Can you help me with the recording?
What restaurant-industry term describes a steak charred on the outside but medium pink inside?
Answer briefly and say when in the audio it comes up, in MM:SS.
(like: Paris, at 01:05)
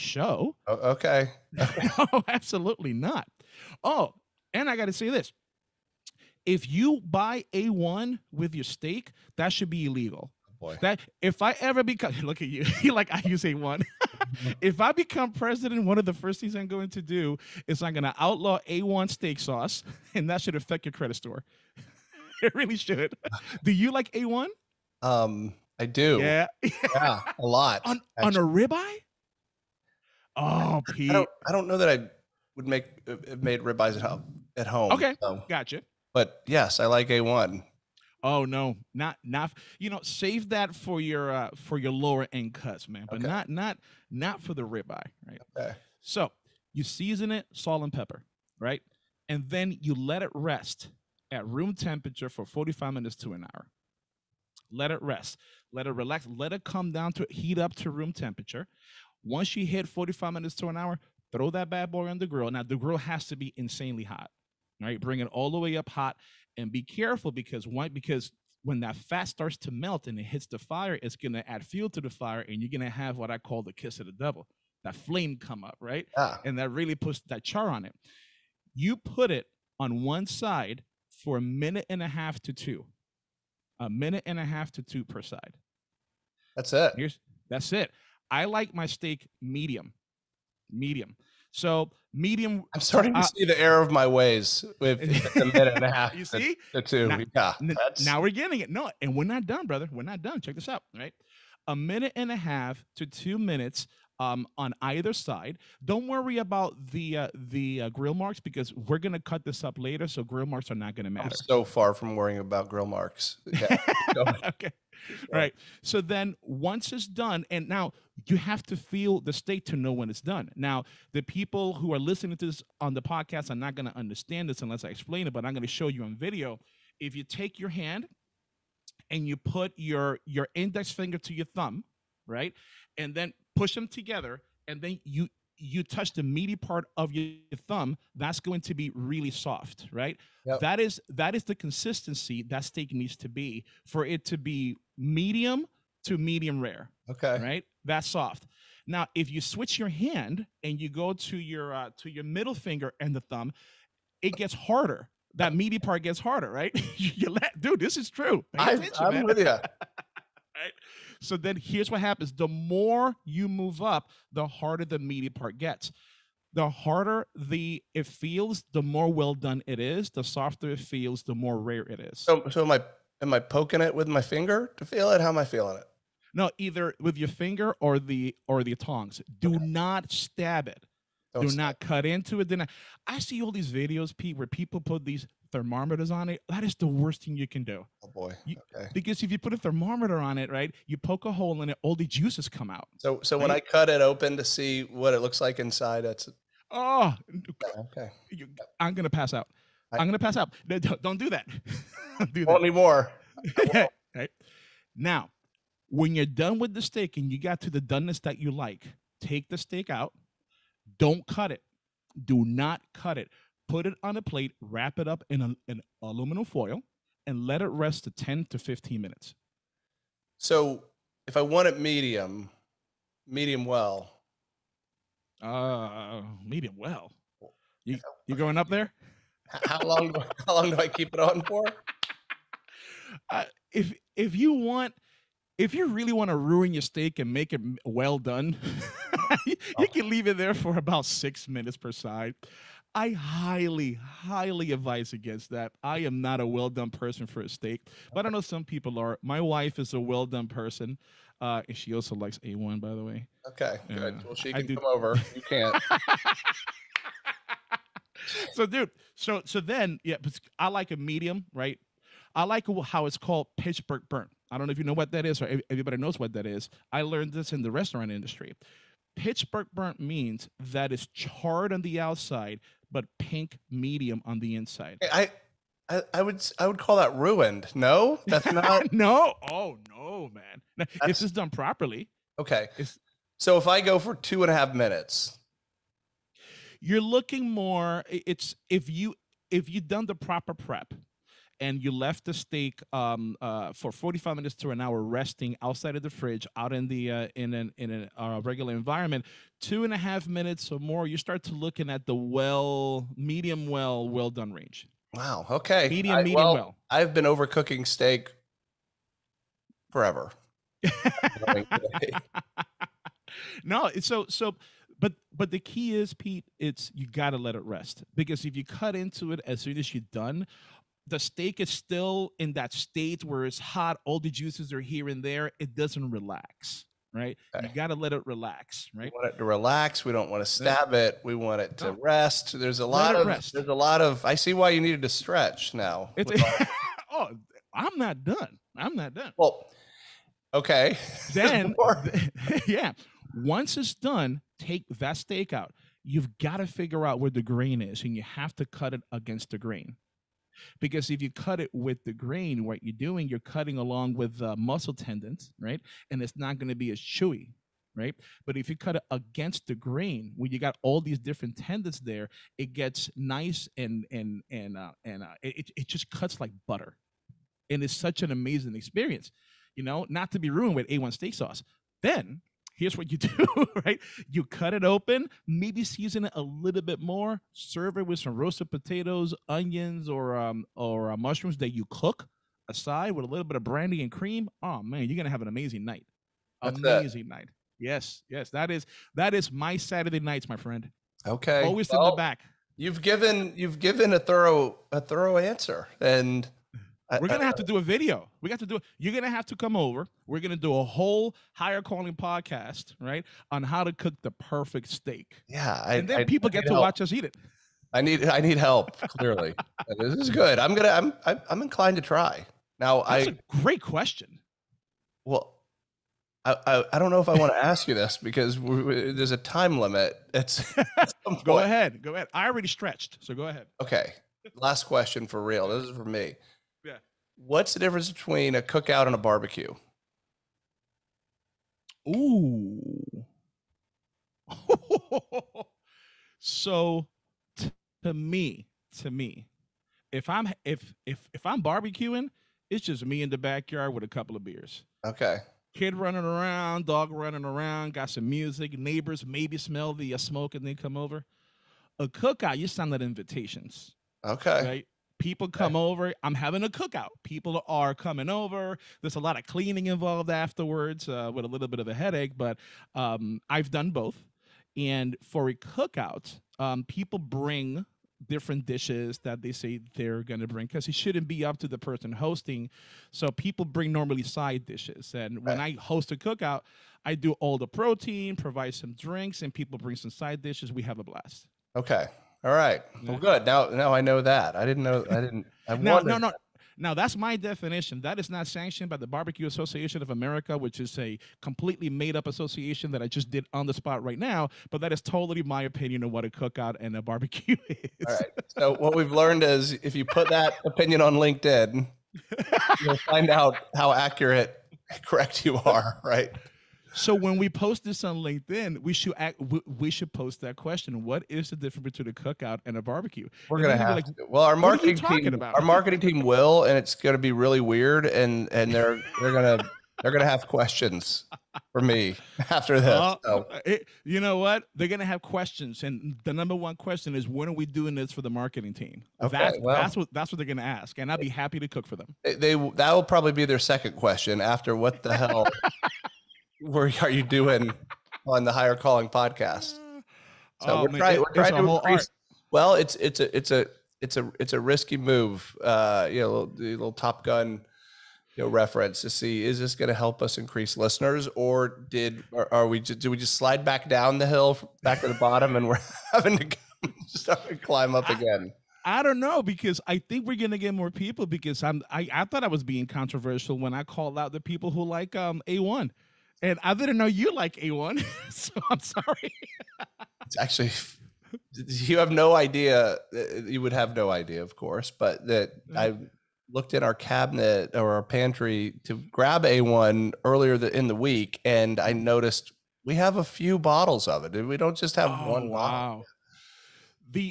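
Pittsburgh burn, at 04:23.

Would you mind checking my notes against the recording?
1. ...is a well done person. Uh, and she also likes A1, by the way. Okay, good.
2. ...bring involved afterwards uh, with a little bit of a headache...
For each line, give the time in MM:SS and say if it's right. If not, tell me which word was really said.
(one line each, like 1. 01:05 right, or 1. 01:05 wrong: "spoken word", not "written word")
1. 04:09 right
2. 07:39 wrong: "cleaning", not "bring".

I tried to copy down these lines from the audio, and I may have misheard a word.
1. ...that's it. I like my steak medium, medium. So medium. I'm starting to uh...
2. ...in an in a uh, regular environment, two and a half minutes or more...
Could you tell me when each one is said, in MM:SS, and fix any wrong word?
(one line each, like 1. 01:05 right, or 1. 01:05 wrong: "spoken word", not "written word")
1. 01:27 right
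2. 04:57 right.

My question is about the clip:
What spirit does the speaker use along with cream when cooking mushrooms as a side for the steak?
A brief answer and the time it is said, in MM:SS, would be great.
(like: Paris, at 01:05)
brandy, at 06:23.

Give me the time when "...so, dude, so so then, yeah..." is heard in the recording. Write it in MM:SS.
04:18.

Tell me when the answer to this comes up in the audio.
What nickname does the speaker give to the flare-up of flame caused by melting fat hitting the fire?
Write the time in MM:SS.
01:13.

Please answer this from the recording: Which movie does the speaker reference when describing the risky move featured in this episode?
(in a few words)
Top Gun.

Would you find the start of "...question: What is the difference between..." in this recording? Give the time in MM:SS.
08:30.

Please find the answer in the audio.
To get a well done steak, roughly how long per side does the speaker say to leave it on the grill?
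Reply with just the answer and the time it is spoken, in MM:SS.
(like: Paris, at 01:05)
about 6 minutes, at 04:00.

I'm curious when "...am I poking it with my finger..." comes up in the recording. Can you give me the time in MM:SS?
02:53.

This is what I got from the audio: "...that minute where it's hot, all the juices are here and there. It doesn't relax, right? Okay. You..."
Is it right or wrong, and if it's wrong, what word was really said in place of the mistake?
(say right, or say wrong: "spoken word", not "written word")
wrong: "state", not "minute".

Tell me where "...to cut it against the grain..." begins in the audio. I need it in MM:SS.
05:48.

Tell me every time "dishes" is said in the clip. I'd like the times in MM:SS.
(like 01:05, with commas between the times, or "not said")
07:48, 07:54, 08:00.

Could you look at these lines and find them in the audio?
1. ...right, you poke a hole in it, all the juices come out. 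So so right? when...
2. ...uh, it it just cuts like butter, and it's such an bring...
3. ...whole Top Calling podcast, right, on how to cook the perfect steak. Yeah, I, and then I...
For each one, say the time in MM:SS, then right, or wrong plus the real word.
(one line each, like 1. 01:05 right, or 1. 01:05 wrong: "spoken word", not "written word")
1. 03:10 right
2. 06:05 wrong: "amazing", not "bring"
3. 06:40 wrong: "Hire", not "Top".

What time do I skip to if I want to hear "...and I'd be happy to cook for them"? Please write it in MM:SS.
08:50.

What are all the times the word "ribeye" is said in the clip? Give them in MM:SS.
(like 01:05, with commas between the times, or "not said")
00:28, 00:33, 00:44.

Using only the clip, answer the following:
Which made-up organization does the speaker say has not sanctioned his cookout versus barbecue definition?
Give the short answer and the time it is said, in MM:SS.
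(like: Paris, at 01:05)
Barbecue Association of America, at 08:09.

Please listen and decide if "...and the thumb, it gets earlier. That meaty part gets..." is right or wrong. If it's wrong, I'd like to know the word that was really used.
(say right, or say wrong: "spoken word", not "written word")
wrong: "harder", not "earlier".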